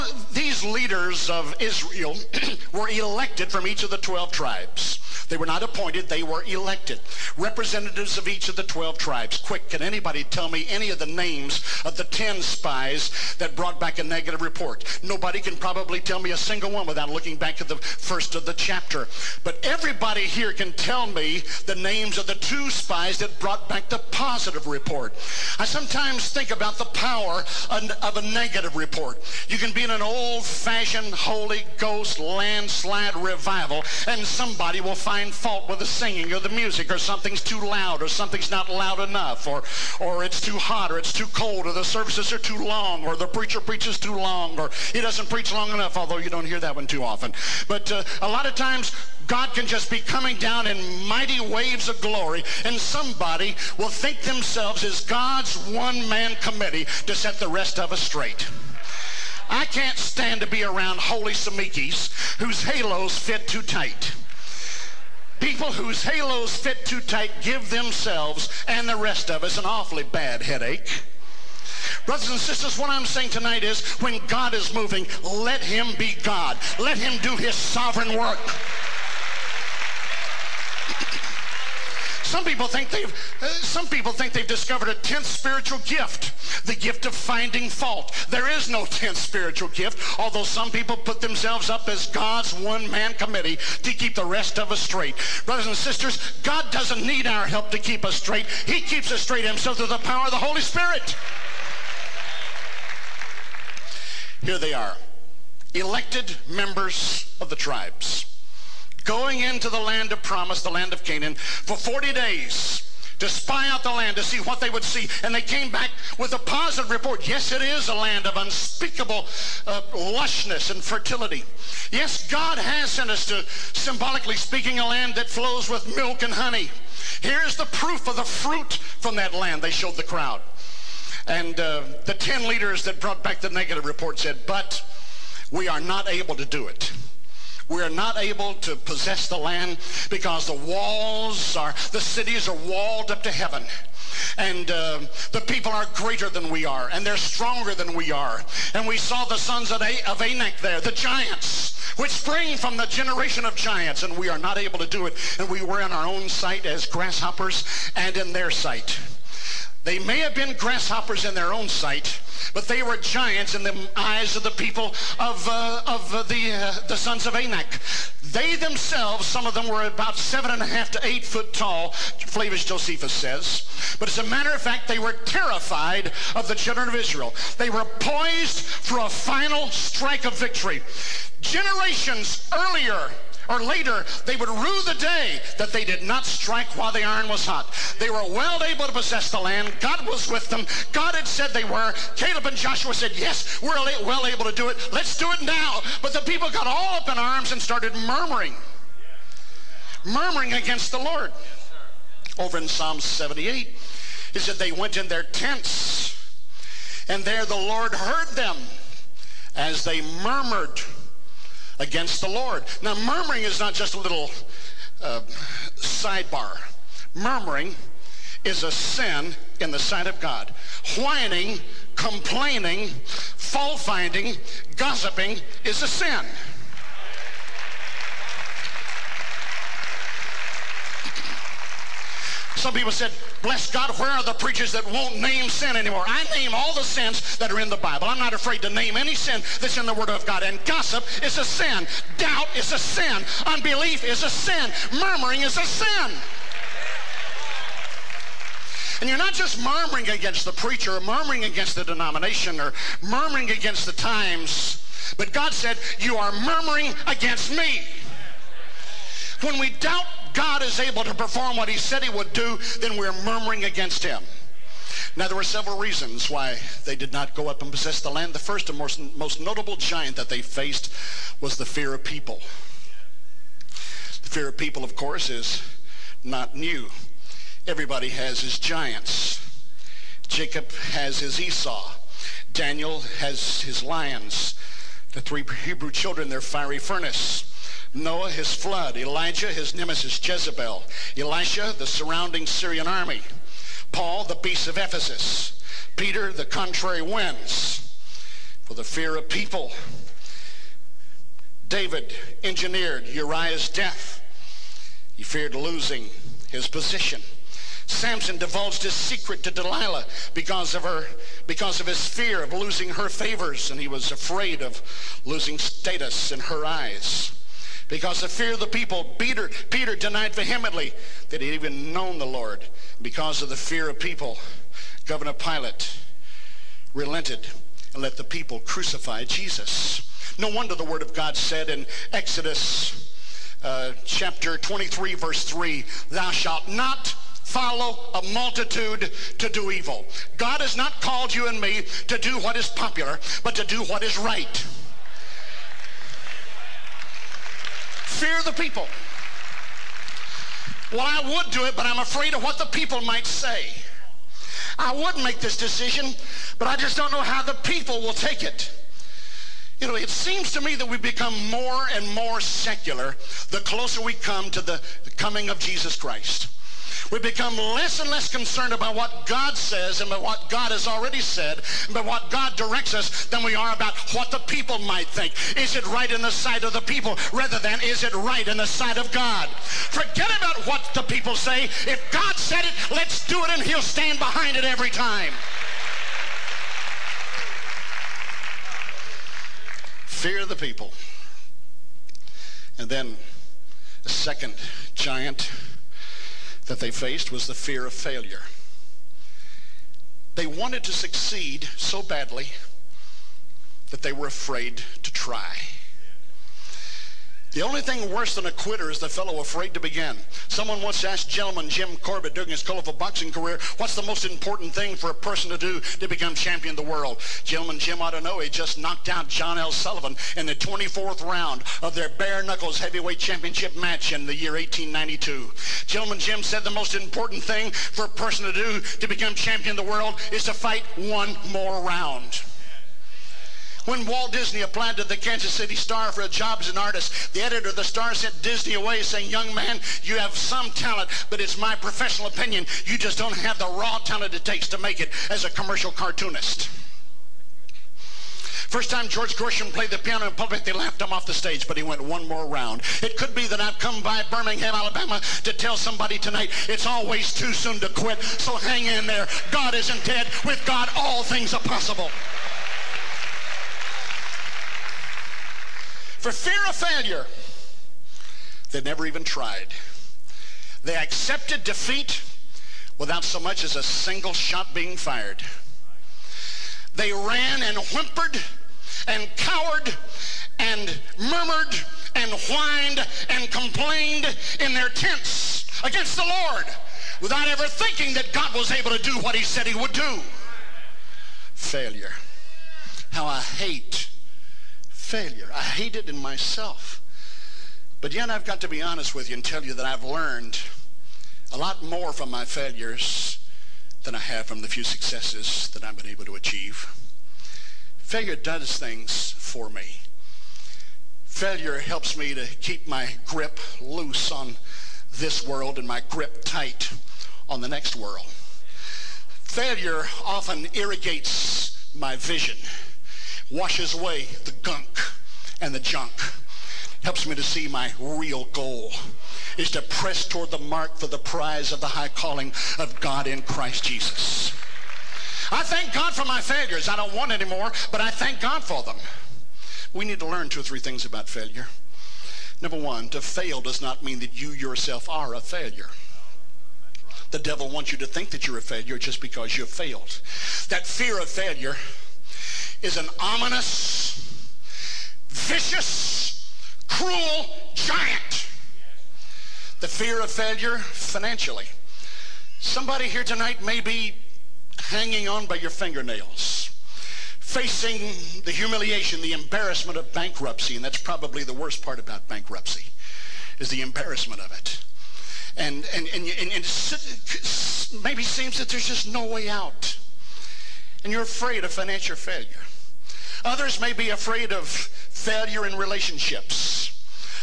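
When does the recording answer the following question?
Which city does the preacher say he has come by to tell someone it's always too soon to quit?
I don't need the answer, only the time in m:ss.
7:34.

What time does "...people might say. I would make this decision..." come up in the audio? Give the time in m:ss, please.
5:52.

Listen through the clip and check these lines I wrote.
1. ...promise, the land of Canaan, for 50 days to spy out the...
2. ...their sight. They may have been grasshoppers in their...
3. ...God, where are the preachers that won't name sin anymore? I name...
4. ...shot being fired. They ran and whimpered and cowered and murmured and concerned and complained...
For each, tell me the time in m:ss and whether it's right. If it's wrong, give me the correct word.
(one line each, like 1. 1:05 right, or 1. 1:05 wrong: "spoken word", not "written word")
1. 1:50 wrong: "40", not "50"
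2. 2:38 right
3. 3:53 right
4. 7:54 wrong: "whined", not "concerned".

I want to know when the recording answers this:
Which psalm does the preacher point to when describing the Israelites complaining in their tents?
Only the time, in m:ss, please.
3:22.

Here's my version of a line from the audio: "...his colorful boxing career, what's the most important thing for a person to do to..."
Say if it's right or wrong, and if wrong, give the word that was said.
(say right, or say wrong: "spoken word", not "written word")
right.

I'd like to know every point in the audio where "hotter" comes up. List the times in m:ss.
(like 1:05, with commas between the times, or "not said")
not said.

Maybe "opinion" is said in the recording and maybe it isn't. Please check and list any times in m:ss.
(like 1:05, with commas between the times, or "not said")
7:22.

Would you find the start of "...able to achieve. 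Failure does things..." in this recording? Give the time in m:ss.
8:26.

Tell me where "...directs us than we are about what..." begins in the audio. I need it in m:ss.
6:12.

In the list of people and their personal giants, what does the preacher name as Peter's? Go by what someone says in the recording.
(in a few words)
the contrary winds.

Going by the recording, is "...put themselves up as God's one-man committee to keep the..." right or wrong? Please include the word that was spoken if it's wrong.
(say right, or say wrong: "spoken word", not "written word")
right.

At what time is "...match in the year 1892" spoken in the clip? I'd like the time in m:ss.
7:03.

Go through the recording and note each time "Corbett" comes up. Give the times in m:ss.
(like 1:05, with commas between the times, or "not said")
6:51.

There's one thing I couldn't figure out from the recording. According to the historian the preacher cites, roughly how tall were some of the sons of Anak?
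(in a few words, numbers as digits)
7.5 to 8 feet.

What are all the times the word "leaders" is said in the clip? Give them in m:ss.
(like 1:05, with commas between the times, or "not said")
0:00, 2:12.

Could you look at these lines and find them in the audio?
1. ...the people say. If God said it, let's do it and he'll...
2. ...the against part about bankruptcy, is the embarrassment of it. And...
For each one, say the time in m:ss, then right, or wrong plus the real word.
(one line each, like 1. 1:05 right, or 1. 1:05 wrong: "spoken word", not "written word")
1. 6:20 right
2. 9:31 wrong: "worst", not "against".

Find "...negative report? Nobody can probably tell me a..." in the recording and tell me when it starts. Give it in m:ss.
0:14.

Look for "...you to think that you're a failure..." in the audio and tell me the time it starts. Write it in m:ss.
9:07.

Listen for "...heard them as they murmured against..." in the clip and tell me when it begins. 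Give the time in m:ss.
3:27.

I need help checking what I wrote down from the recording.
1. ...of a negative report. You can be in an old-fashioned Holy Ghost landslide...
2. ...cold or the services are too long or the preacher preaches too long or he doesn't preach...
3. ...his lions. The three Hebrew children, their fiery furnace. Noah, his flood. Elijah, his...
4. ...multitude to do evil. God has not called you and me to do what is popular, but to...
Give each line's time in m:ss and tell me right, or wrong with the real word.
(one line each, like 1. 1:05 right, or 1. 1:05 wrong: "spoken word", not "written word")
1. 0:27 right
2. 0:41 right
3. 4:43 right
4. 5:38 right.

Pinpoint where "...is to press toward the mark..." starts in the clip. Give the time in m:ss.
8:49.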